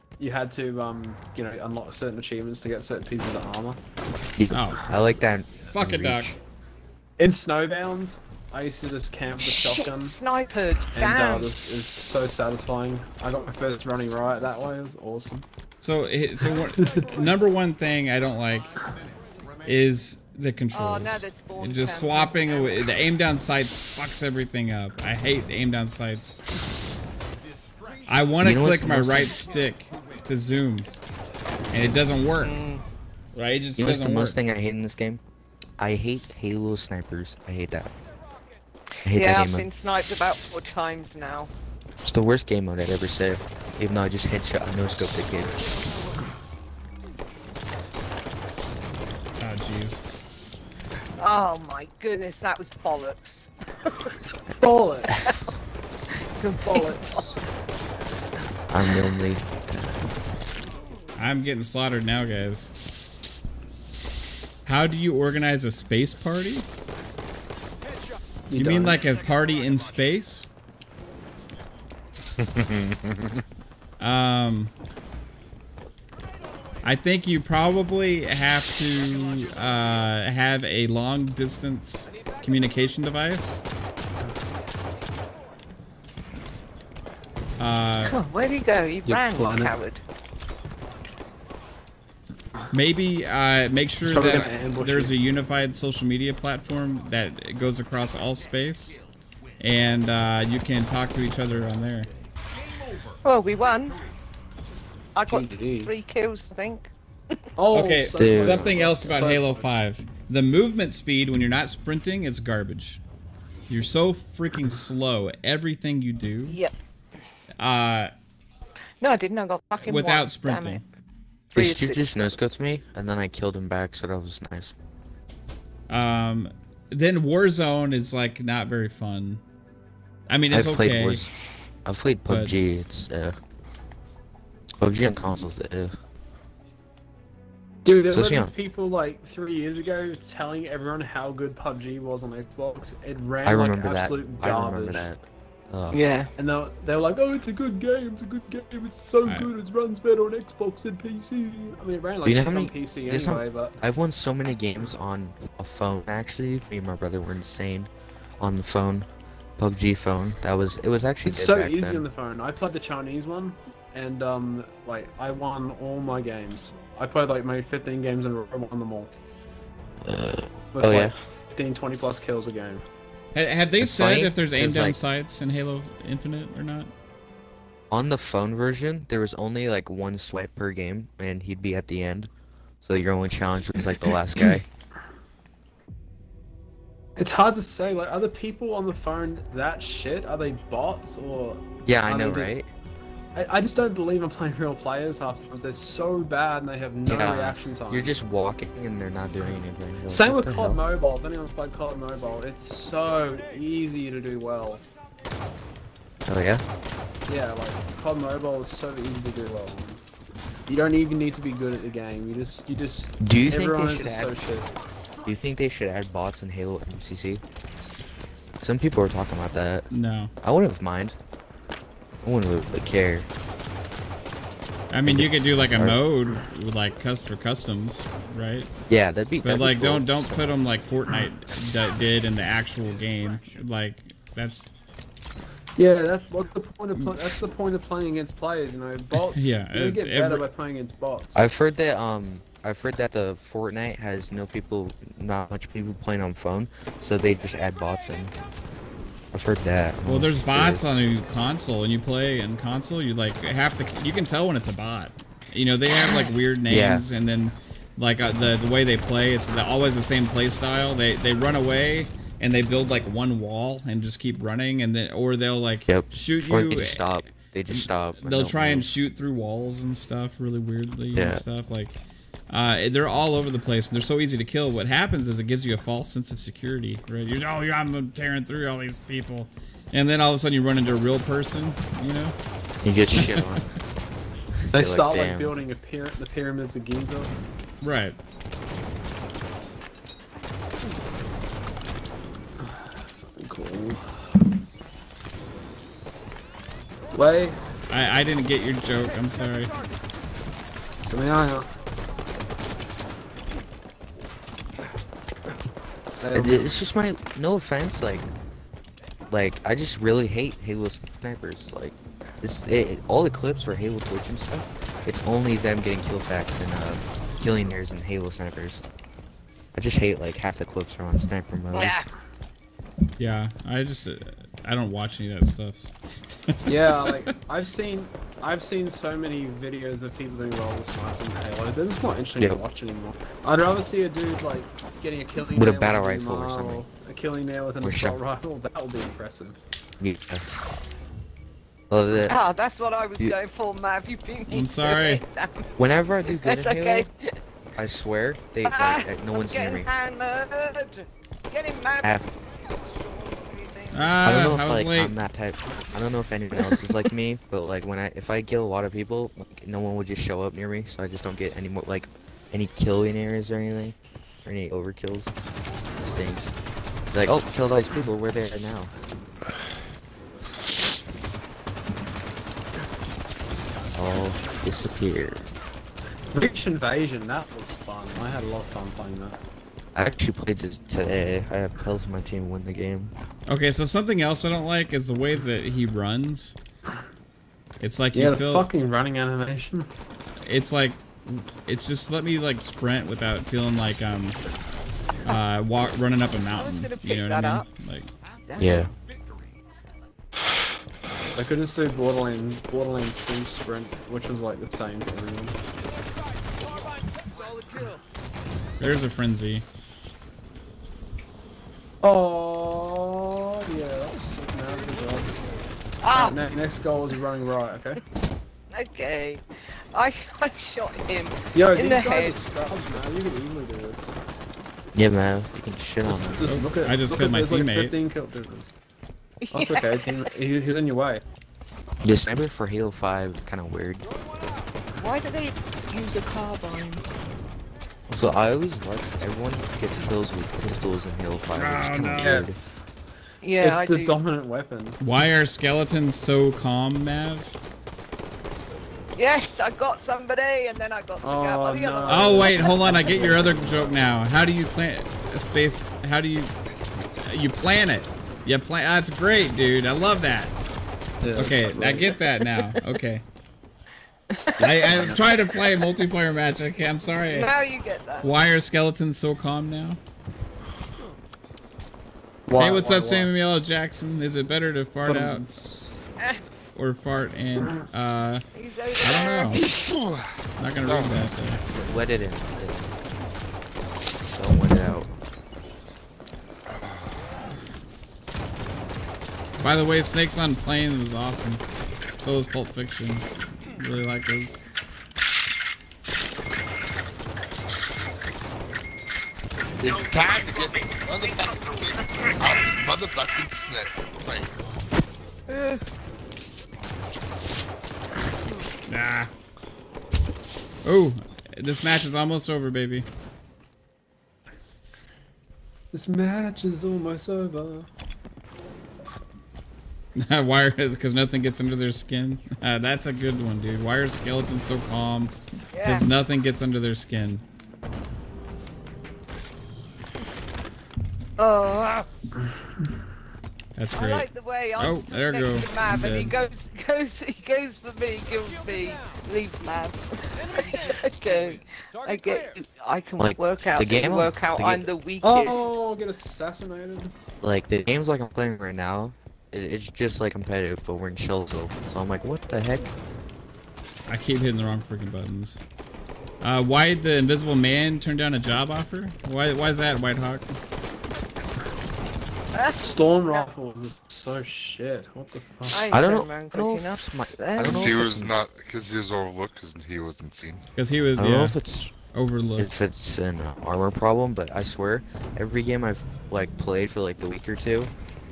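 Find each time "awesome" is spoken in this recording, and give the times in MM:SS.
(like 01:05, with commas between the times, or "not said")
00:15, 08:11.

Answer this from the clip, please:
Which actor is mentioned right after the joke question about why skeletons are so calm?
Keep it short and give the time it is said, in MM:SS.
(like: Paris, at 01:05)
Samuel L. Jackson, at 07:53.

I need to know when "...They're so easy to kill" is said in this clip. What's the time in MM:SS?
04:33.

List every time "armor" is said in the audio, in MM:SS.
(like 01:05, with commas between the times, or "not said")
00:03, 09:33.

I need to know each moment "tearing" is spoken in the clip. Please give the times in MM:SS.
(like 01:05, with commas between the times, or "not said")
04:38.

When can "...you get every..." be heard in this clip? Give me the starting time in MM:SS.
03:59.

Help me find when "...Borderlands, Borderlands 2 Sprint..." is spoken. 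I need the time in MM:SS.
06:41.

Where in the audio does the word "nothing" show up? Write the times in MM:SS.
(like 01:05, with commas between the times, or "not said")
08:41, 08:46.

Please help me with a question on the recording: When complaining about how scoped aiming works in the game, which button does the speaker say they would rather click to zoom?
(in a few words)
right stick.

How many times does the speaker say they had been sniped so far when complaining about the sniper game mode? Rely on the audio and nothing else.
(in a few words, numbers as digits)
4.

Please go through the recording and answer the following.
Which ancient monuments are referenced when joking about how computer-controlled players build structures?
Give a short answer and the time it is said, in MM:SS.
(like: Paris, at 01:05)
pyramids of Giza, at 04:46.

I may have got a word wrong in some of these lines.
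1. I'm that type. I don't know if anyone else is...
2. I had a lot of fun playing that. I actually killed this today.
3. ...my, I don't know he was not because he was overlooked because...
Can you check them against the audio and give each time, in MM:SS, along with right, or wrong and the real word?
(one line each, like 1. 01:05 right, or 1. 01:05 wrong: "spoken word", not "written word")
1. 05:55 right
2. 06:18 wrong: "played", not "killed"
3. 09:27 right.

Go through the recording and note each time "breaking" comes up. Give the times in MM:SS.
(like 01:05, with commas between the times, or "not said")
not said.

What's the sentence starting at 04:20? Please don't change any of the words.
They they run away and they build like one wall and just keep running, and then or they'll like yep.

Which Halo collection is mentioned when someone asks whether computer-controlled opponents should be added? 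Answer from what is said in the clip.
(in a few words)
Halo MCC.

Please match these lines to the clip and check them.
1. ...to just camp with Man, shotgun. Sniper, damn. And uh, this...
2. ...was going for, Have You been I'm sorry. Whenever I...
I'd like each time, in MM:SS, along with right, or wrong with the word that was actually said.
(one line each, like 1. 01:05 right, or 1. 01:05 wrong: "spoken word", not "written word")
1. 00:08 wrong: "Shit", not "Man"
2. 05:43 right.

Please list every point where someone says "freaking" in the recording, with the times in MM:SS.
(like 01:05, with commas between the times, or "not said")
01:54, 09:14.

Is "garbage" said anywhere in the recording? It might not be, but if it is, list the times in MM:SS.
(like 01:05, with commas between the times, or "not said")
01:52, 02:24.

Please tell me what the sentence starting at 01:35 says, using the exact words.
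a unified social media platform that goes across all space, and uh, you can talk to each other on there.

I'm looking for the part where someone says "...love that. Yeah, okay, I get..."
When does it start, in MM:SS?
07:39.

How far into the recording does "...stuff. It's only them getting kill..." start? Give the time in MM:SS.
05:14.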